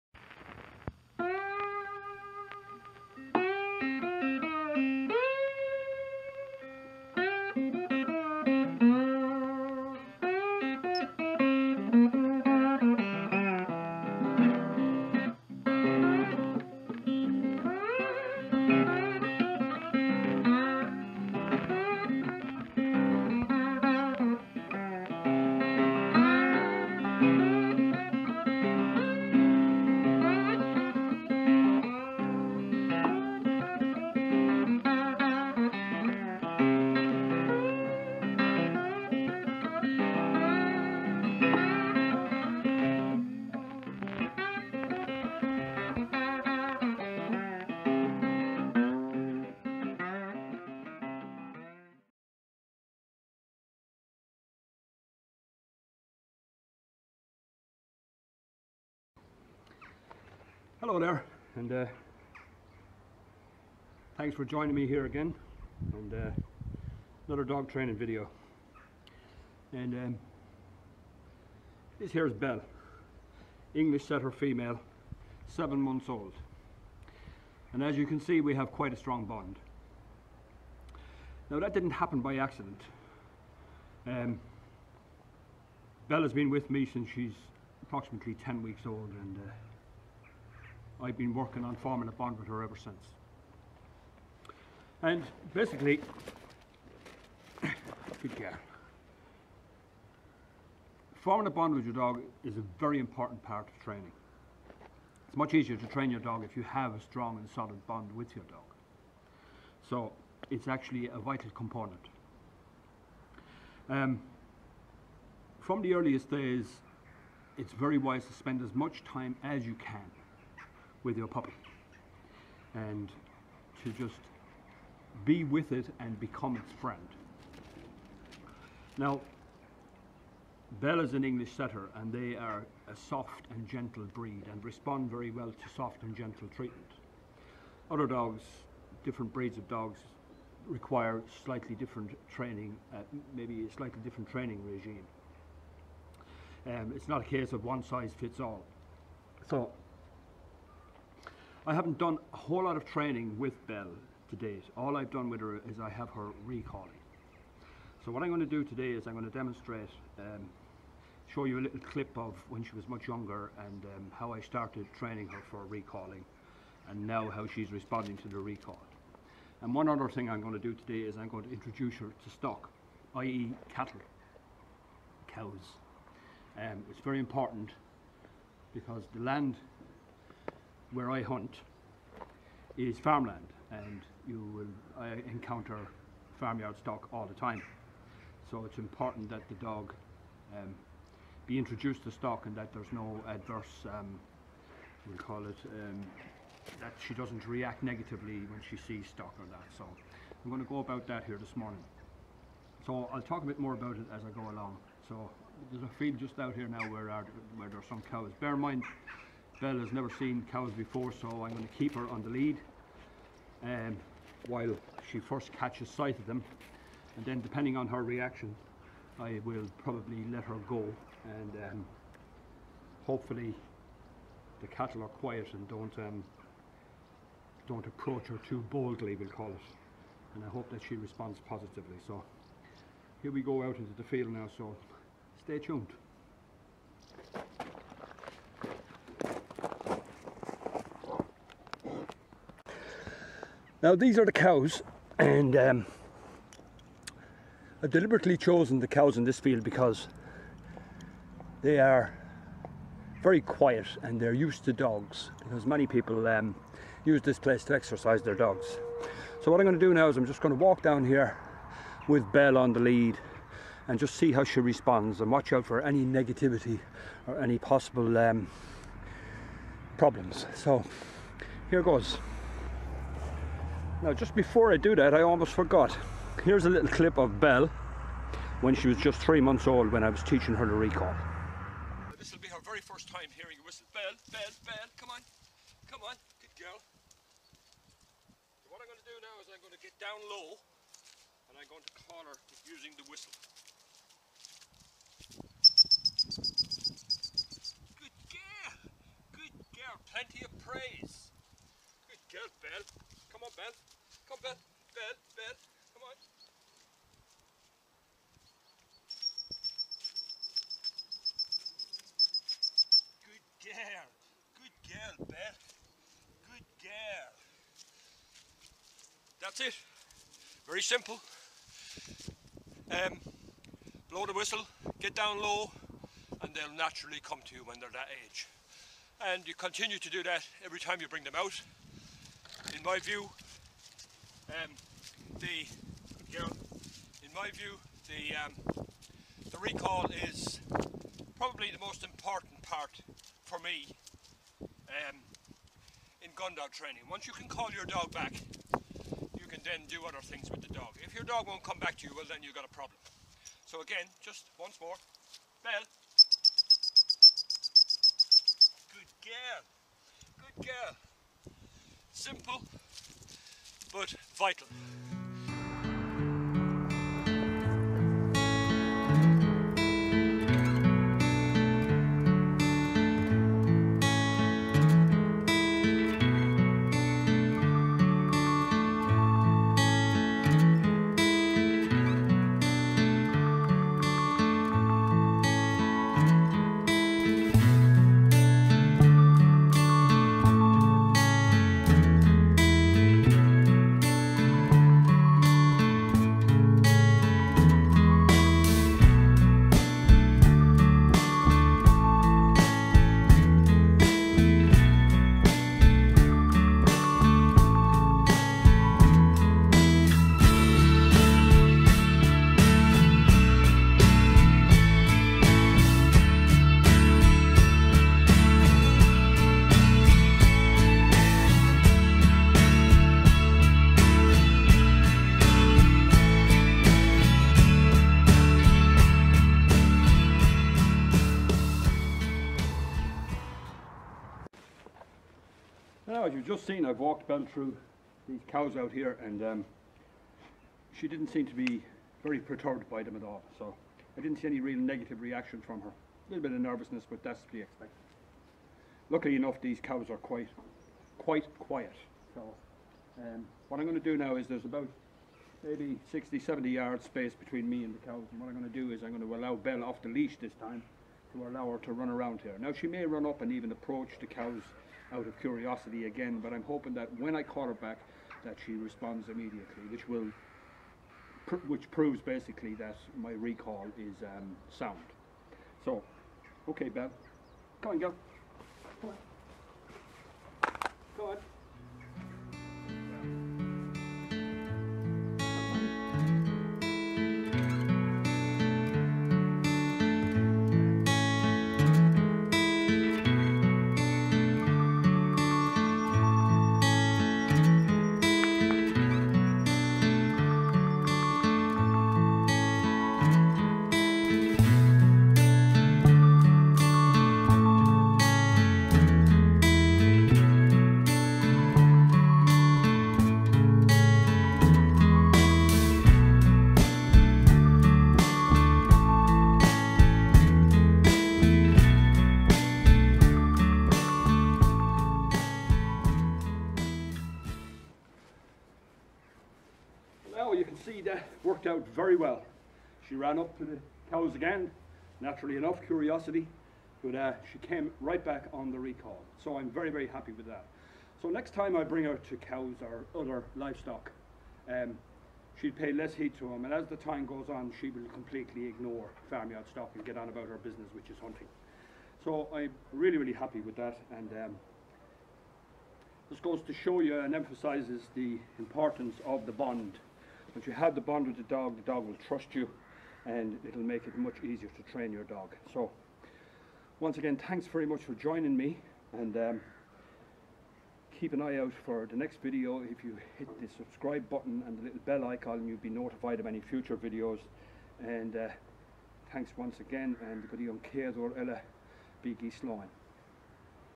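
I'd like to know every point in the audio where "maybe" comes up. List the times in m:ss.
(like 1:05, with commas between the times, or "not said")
2:23, 7:35.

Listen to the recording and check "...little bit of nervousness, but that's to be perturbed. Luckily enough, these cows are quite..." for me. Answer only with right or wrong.
wrong.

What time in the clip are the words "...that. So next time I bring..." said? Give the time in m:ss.
9:00.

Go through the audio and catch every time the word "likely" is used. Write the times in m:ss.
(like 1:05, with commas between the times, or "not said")
not said.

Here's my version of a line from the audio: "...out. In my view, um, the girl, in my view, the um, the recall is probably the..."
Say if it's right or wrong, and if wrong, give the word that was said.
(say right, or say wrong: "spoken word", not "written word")
right.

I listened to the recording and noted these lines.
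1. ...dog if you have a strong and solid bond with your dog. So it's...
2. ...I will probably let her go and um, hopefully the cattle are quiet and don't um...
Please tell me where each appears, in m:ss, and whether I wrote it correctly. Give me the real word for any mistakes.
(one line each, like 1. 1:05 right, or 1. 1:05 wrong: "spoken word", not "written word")
1. 1:46 right
2. 3:39 right.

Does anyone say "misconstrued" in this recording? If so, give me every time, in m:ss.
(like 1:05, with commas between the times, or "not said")
not said.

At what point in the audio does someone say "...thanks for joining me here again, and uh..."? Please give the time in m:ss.
1:04.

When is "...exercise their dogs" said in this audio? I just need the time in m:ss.
4:17.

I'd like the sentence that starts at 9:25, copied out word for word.
So once again, thanks very much for joining me and um, keep an eye out for the next video.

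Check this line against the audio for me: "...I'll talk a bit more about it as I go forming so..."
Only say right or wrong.
wrong.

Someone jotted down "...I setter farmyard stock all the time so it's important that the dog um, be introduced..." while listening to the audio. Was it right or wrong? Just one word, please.
wrong.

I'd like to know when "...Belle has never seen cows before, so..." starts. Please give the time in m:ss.
3:29.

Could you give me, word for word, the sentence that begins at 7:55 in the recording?
So, okay, Bev, come on, girl.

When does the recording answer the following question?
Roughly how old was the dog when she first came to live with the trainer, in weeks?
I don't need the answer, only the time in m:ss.
1:28.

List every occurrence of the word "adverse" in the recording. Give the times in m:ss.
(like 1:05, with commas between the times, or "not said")
3:13.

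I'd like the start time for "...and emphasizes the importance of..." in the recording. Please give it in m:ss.
9:17.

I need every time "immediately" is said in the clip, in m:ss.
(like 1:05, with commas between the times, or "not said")
7:49.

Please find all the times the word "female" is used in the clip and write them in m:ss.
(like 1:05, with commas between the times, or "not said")
1:14.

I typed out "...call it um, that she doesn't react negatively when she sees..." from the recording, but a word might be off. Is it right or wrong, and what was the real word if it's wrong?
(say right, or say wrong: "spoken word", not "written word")
right.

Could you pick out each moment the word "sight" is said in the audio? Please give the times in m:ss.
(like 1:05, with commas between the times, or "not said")
3:35.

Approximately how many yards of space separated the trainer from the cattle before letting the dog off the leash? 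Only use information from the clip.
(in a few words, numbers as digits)
60 to 70.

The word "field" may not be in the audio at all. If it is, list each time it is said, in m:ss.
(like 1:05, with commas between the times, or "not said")
3:25, 3:54, 4:09.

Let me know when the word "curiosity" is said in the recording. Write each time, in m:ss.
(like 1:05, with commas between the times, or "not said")
7:45, 8:55.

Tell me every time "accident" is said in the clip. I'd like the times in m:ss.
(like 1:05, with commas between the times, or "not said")
1:22.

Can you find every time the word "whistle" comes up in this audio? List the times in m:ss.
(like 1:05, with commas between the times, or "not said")
4:43, 4:53, 5:24.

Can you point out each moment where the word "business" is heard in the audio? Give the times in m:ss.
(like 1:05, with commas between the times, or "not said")
9:10.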